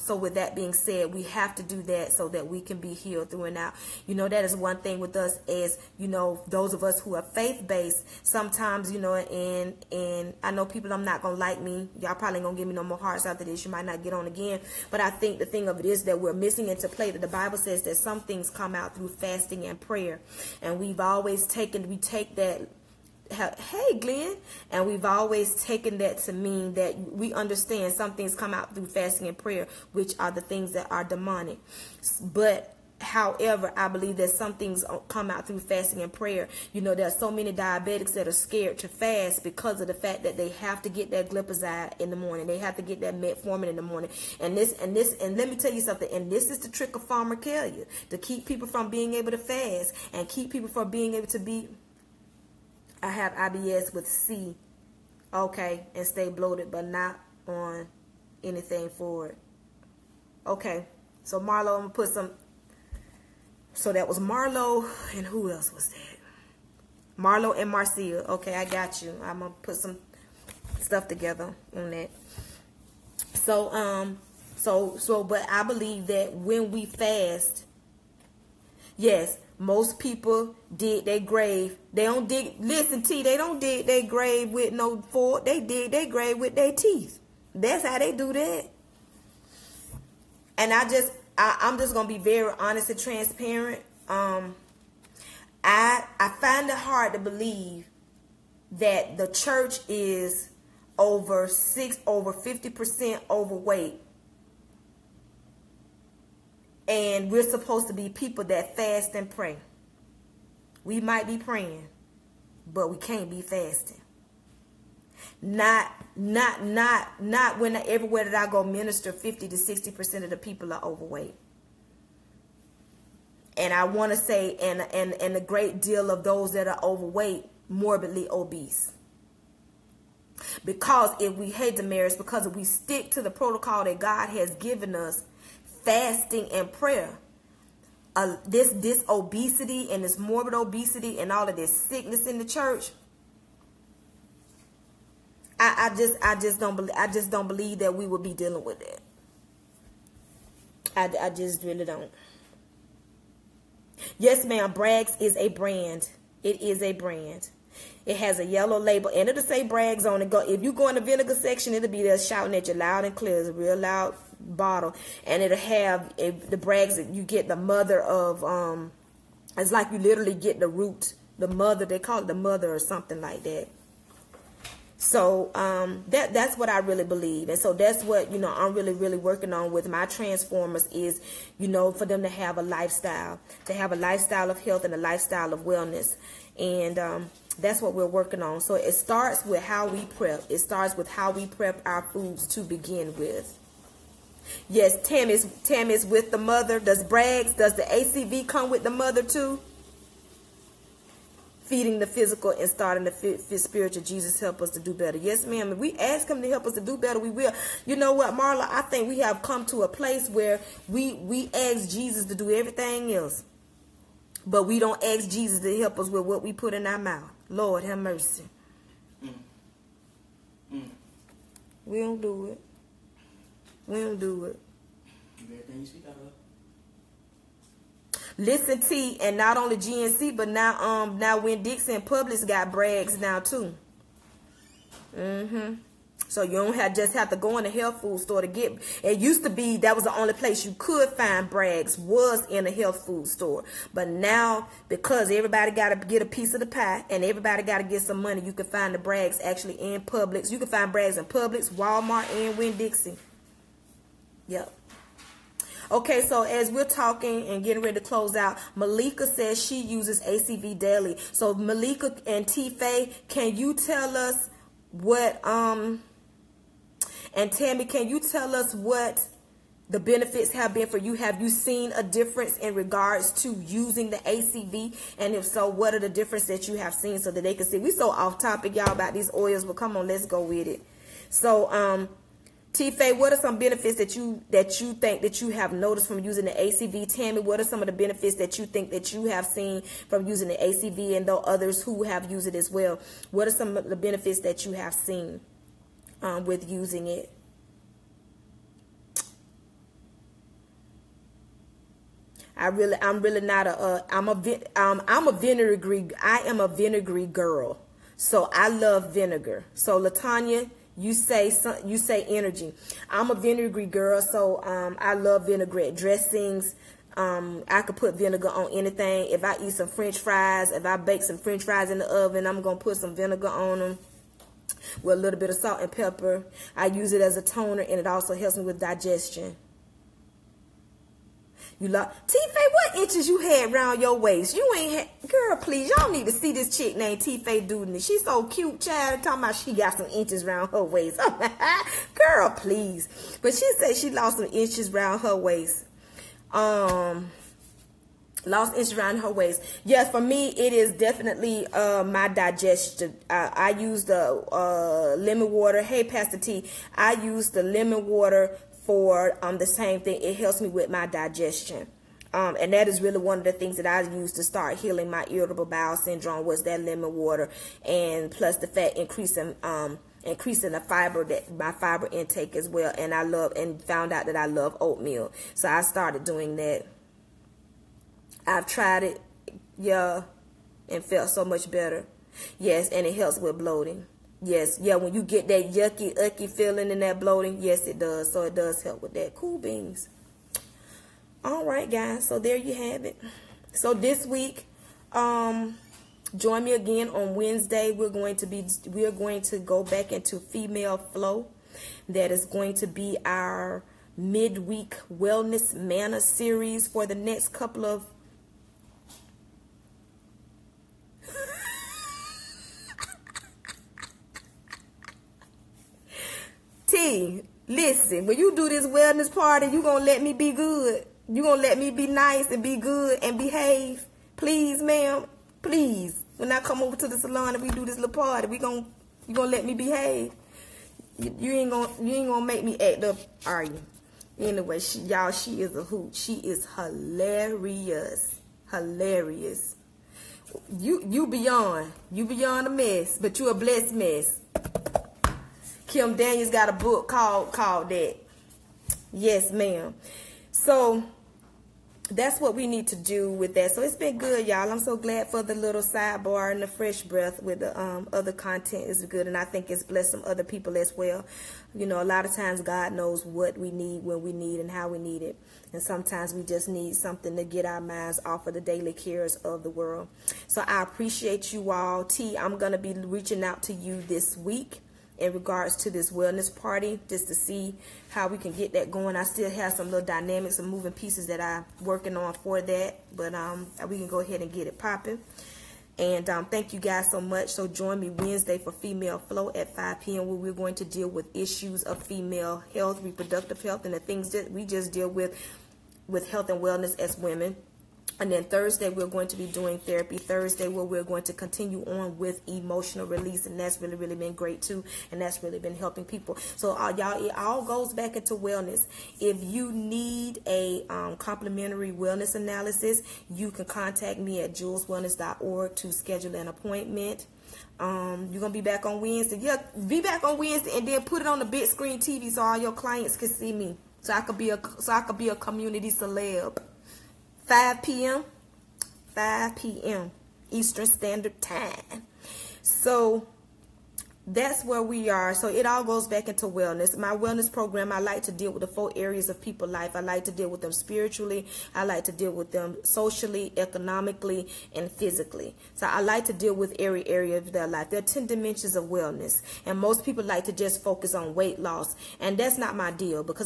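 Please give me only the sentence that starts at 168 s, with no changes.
Um, it's like you literally get the root, the mother.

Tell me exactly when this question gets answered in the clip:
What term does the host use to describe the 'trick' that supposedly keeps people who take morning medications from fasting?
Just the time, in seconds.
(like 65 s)
47 s.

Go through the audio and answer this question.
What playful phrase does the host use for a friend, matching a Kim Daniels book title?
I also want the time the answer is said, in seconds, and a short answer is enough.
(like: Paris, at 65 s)
A Blessed Mess, at 443 s.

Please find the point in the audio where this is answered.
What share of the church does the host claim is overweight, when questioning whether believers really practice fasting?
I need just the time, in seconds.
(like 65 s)
102 s.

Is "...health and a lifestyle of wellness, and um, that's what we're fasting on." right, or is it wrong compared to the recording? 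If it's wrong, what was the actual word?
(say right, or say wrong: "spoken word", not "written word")
wrong: "working", not "fasting".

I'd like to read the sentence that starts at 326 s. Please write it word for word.
I use it as a toner, and it also helps me with digestion.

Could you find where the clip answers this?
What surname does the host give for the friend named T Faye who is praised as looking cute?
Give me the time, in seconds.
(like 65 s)
337 s.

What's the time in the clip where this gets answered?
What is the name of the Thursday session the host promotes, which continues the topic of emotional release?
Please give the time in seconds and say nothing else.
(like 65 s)
499 s.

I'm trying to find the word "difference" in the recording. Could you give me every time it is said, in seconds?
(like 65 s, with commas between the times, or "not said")
272 s, 276 s.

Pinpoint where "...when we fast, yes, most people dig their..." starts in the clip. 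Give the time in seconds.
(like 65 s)
76 s.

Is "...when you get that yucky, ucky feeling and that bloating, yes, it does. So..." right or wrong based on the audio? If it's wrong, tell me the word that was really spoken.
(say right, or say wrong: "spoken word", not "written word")
right.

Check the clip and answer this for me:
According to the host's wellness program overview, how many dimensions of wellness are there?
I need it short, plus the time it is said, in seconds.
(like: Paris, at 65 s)
10, at 548 s.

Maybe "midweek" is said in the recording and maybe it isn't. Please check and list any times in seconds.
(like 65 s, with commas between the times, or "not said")
404 s.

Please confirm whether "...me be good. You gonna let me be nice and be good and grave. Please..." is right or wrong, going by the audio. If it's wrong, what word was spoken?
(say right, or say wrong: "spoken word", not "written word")
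wrong: "behave", not "grave".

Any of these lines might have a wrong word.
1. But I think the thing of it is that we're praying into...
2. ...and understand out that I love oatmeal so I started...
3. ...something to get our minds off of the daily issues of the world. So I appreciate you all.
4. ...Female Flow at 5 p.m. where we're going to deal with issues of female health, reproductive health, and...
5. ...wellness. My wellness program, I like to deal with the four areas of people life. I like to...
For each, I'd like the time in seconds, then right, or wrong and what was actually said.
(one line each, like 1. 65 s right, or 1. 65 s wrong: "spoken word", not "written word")
1. 14 s wrong: "missing", not "praying"
2. 373 s wrong: "found", not "understand"
3. 466 s wrong: "cares", not "issues"
4. 488 s right
5. 536 s right.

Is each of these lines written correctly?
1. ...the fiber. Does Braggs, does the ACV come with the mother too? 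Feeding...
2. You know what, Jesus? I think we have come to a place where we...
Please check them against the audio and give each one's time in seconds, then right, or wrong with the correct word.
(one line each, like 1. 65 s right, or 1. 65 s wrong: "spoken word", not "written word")
1. 196 s wrong: "mother", not "fiber"
2. 207 s wrong: "Marla", not "Jesus".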